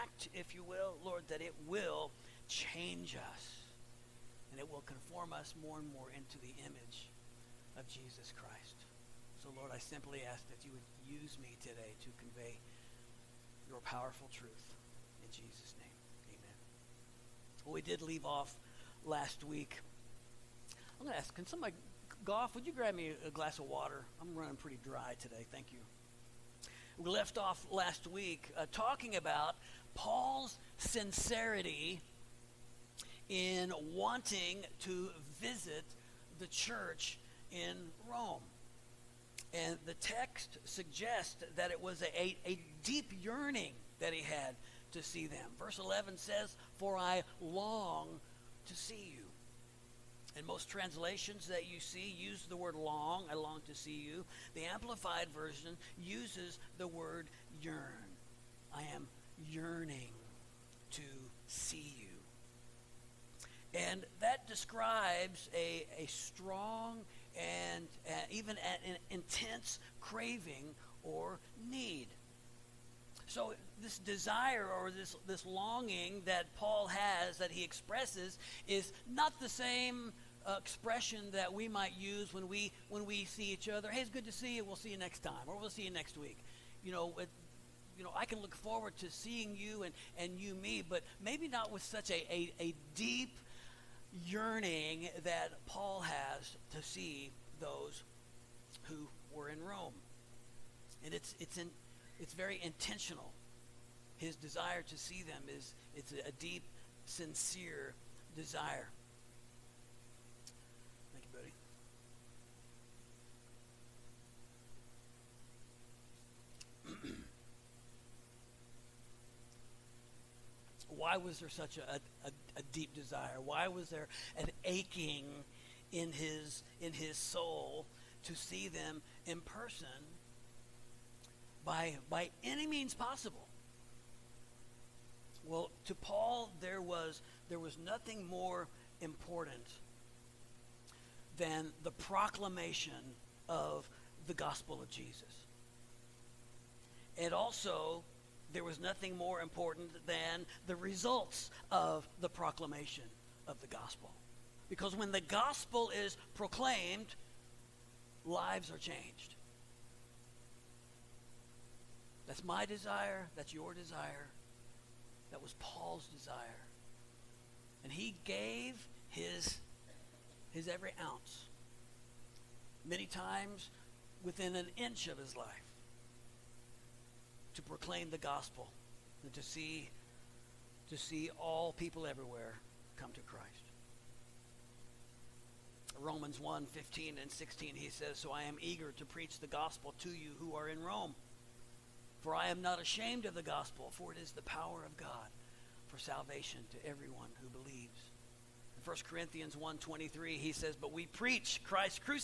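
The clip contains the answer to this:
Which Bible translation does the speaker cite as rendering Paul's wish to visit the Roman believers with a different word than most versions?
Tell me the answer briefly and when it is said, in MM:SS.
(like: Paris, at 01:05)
Amplified Version, at 00:54.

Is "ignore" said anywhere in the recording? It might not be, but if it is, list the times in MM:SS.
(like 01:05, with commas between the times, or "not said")
not said.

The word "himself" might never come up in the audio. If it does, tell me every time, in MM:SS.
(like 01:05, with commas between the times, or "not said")
not said.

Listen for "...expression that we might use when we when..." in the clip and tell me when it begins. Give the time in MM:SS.
01:20.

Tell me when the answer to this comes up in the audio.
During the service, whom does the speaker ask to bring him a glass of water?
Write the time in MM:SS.
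00:22.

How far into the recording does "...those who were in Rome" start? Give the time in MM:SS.
01:37.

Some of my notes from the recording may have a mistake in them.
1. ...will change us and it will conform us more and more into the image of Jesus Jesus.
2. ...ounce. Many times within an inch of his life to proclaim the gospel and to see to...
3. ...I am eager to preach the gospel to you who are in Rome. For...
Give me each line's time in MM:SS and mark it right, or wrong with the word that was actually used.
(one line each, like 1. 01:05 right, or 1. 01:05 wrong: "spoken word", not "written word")
1. 00:01 wrong: "Christ", not "Jesus"
2. 02:51 right
3. 03:08 right.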